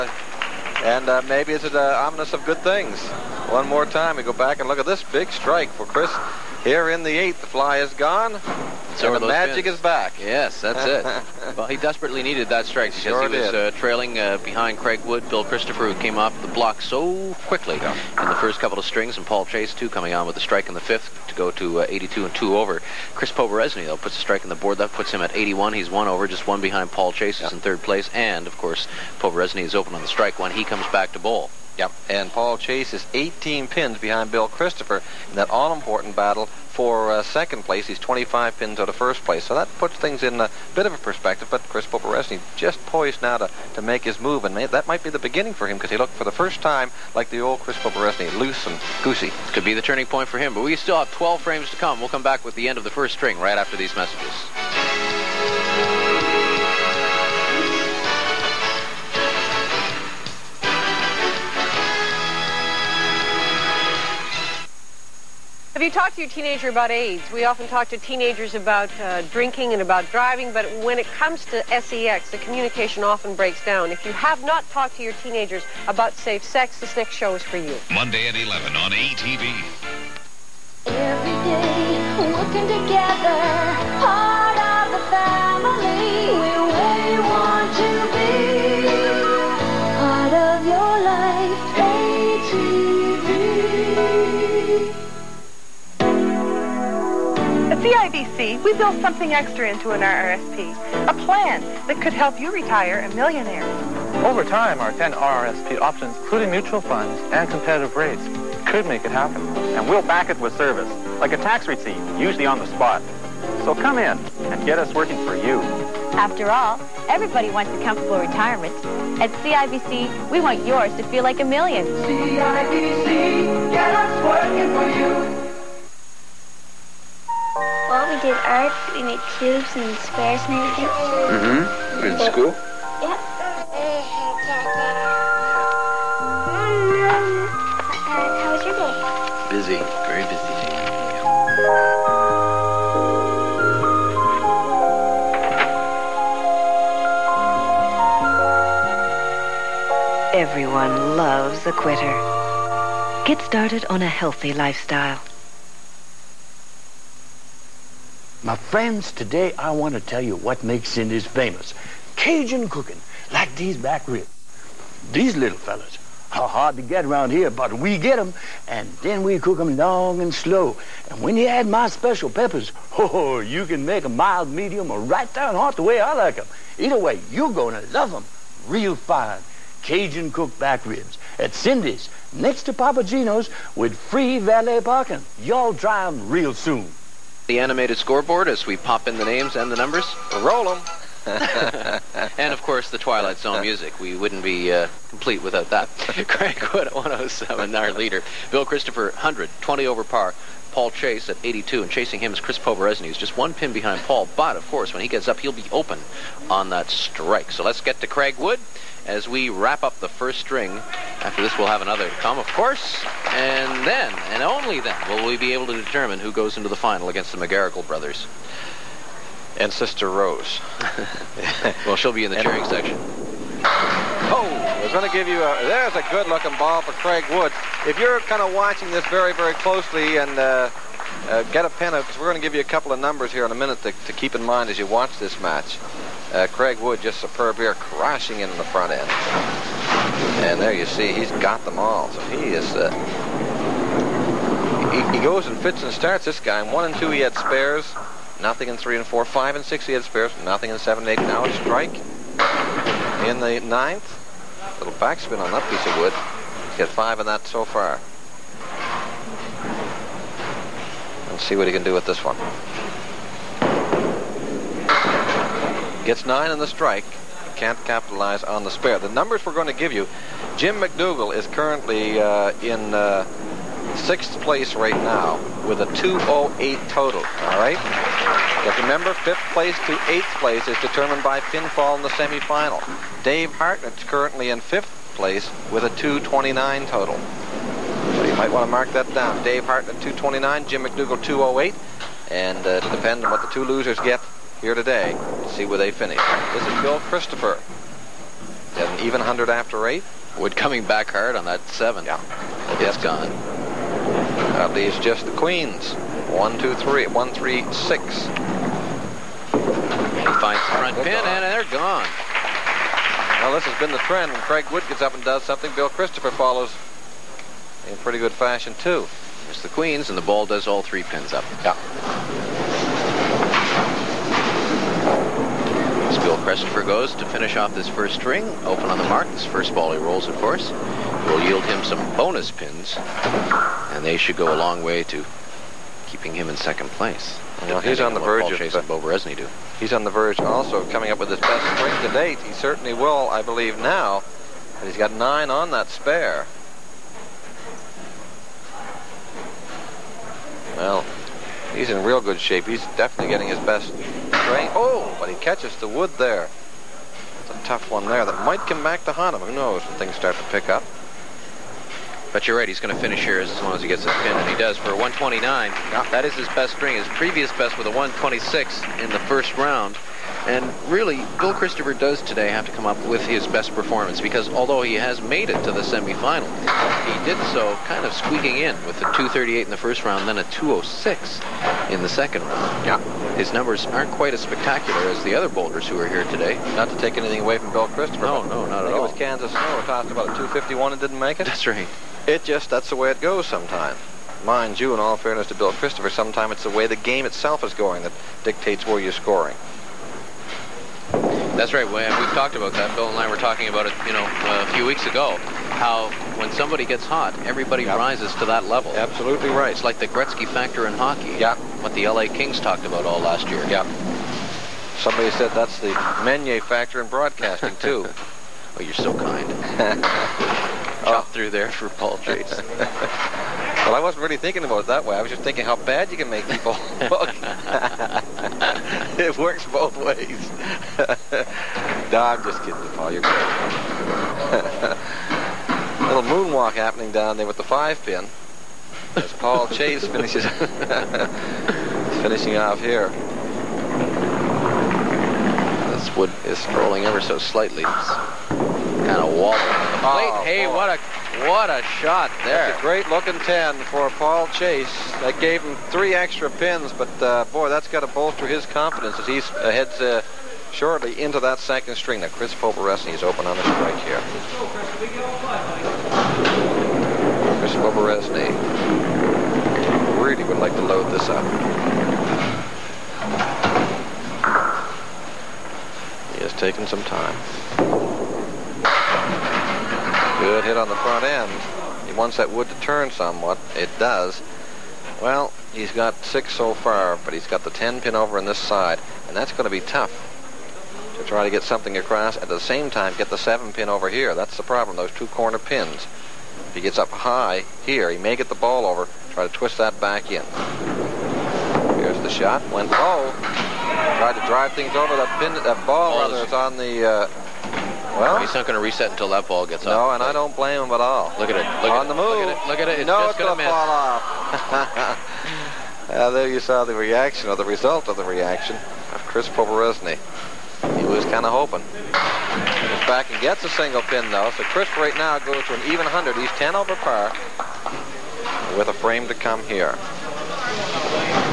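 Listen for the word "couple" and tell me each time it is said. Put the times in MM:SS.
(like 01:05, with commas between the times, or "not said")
00:18, 03:52.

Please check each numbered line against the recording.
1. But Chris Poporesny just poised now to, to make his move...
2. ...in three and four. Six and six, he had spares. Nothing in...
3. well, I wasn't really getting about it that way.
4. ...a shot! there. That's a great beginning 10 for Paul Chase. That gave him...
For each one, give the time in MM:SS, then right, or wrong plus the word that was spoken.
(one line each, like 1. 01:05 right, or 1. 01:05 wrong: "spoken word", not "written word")
1. 00:41 right
2. 04:08 wrong: "Five", not "Six"
3. 07:02 wrong: "thinking", not "getting"
4. 07:31 wrong: "looking", not "beginning".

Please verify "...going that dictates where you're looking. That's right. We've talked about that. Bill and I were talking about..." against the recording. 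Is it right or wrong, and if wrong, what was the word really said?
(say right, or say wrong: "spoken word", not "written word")
wrong: "scoring", not "looking".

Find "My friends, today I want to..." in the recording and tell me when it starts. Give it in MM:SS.
02:38.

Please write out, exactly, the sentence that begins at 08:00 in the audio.
Good hit on the front end wants that wood to turn somewhat.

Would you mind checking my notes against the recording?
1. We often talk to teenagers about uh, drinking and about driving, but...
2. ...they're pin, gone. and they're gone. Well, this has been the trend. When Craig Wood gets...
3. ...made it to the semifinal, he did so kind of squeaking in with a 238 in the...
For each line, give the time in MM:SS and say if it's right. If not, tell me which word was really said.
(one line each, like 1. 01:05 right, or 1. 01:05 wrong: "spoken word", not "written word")
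1. 01:07 right
2. 05:10 right
3. 06:15 right.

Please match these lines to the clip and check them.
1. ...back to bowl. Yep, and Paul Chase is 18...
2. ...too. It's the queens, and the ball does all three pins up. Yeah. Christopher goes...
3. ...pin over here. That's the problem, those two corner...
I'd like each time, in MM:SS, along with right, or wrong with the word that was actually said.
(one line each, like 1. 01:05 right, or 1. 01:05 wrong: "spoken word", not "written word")
1. 00:30 right
2. 05:18 right
3. 08:13 right.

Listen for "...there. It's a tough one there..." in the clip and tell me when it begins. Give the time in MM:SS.
05:56.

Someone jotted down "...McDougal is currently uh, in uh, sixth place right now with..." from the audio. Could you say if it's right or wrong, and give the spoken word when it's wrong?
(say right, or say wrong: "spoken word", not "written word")
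right.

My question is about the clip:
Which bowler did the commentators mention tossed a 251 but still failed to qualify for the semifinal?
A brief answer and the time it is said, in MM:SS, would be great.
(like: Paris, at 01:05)
Kansas Snow, at 06:29.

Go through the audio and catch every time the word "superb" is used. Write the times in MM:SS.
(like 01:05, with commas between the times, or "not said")
03:57.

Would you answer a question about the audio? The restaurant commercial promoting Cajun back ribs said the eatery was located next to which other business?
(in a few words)
Papagino's.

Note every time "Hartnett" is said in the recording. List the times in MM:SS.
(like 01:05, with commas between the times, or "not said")
04:43, 04:49.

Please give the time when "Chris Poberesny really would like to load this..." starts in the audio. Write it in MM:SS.
07:47.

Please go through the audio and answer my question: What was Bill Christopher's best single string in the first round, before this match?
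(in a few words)
126.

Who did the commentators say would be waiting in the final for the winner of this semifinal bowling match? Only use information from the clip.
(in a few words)
The McGarrigle brothers.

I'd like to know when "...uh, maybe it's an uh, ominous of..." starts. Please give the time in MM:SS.
00:01.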